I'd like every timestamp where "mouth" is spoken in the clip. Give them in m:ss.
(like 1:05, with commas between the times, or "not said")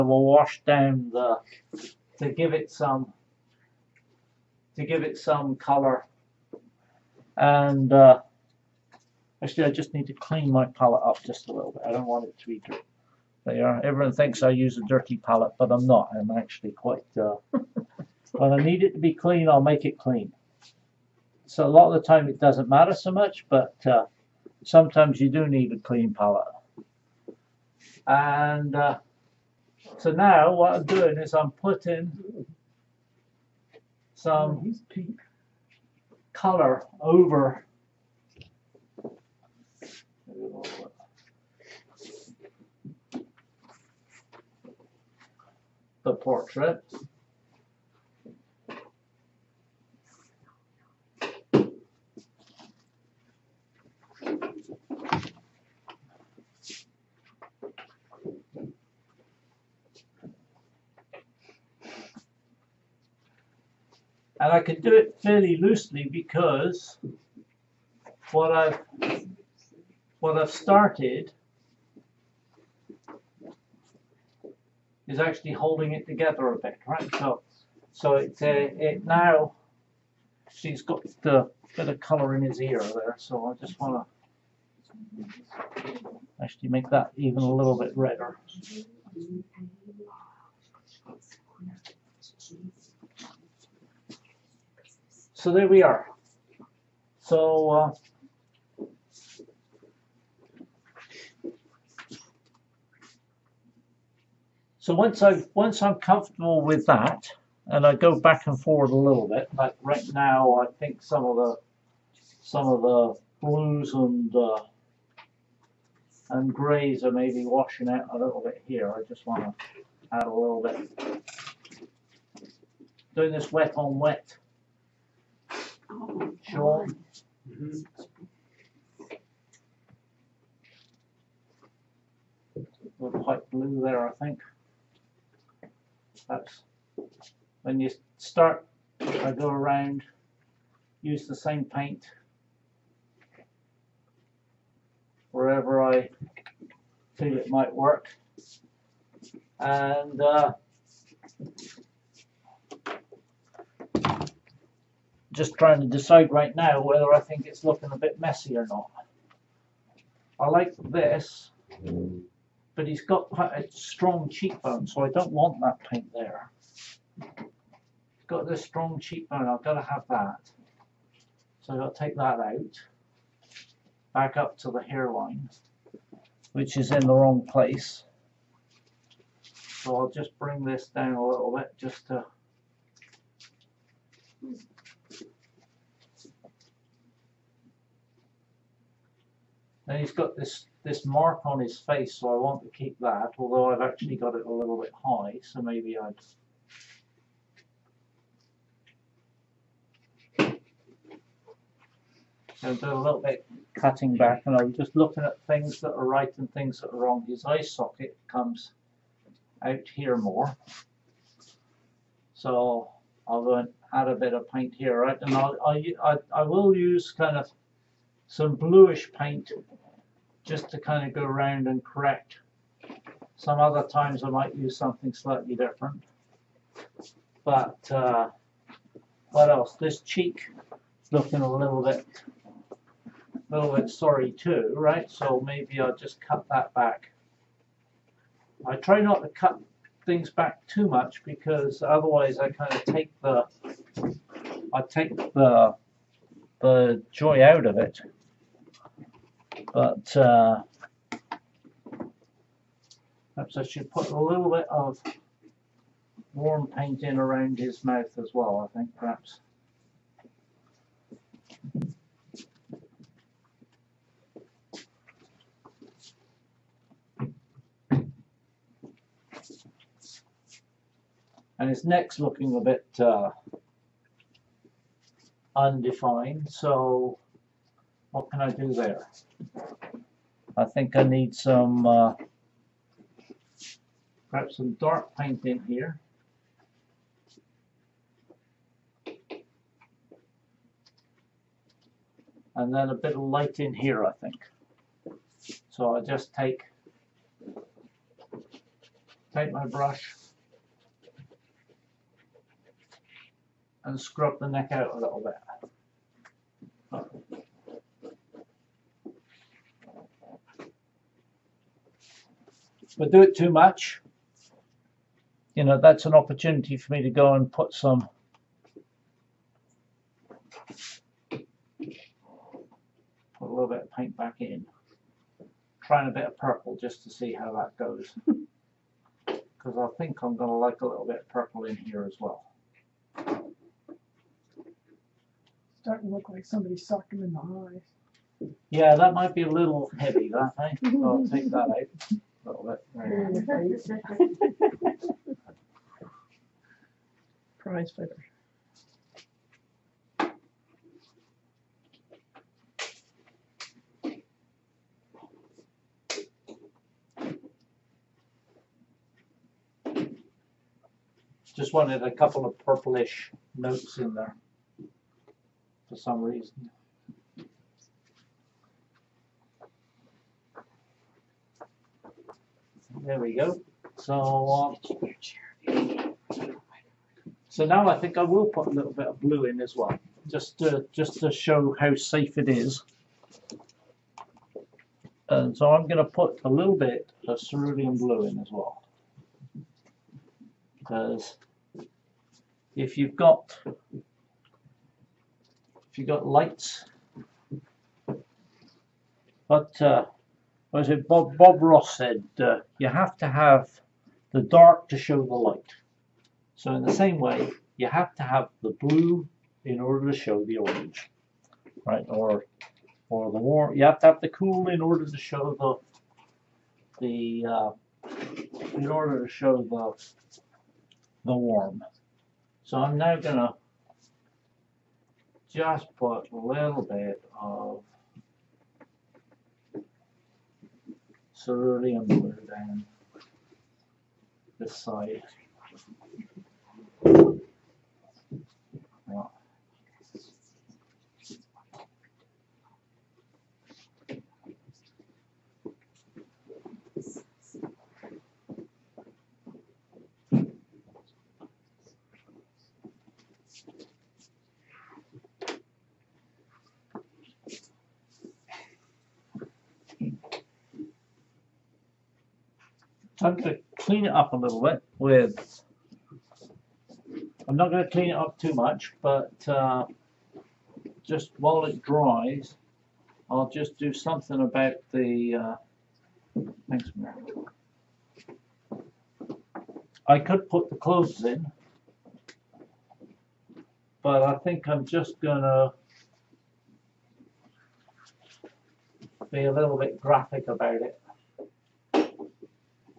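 4:17.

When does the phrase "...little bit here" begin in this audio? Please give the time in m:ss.
1:58.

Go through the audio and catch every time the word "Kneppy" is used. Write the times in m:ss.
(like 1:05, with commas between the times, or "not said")
not said.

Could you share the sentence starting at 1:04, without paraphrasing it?
And I can do it fairly loosely because what I've what I've started is actually holding it together a bit, right?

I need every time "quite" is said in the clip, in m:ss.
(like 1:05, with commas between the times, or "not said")
0:16, 2:43.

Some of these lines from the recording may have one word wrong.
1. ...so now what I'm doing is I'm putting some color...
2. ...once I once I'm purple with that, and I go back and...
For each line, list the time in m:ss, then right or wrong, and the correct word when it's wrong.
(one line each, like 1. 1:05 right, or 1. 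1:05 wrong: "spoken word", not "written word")
1. 0:29 right
2. 1:44 wrong: "comfortable", not "purple".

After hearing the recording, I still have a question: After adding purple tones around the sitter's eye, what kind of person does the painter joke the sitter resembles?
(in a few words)
prize fighter.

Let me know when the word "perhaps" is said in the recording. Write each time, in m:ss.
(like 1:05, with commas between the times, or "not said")
4:13, 4:18, 4:44.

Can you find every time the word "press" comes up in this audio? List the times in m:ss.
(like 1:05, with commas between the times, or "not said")
not said.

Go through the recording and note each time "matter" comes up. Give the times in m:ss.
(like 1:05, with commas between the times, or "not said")
0:22.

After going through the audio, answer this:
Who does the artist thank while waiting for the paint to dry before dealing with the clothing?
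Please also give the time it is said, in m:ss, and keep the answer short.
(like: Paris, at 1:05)
Mary, at 7:56.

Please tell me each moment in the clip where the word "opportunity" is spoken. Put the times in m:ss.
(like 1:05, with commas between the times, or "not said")
5:16.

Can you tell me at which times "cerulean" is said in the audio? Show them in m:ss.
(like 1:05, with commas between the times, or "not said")
6:27, 7:11.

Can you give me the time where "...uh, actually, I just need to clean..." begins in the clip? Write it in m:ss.
0:07.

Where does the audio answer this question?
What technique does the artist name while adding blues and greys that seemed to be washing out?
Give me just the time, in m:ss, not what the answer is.
2:03.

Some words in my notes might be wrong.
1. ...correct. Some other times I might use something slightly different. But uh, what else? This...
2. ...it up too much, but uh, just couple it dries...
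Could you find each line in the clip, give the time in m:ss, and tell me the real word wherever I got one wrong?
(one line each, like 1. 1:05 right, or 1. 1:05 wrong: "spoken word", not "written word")
1. 3:41 right
2. 7:48 wrong: "while", not "couple".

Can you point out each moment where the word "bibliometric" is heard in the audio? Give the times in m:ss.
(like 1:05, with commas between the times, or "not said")
not said.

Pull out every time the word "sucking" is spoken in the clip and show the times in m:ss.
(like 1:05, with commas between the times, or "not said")
5:36.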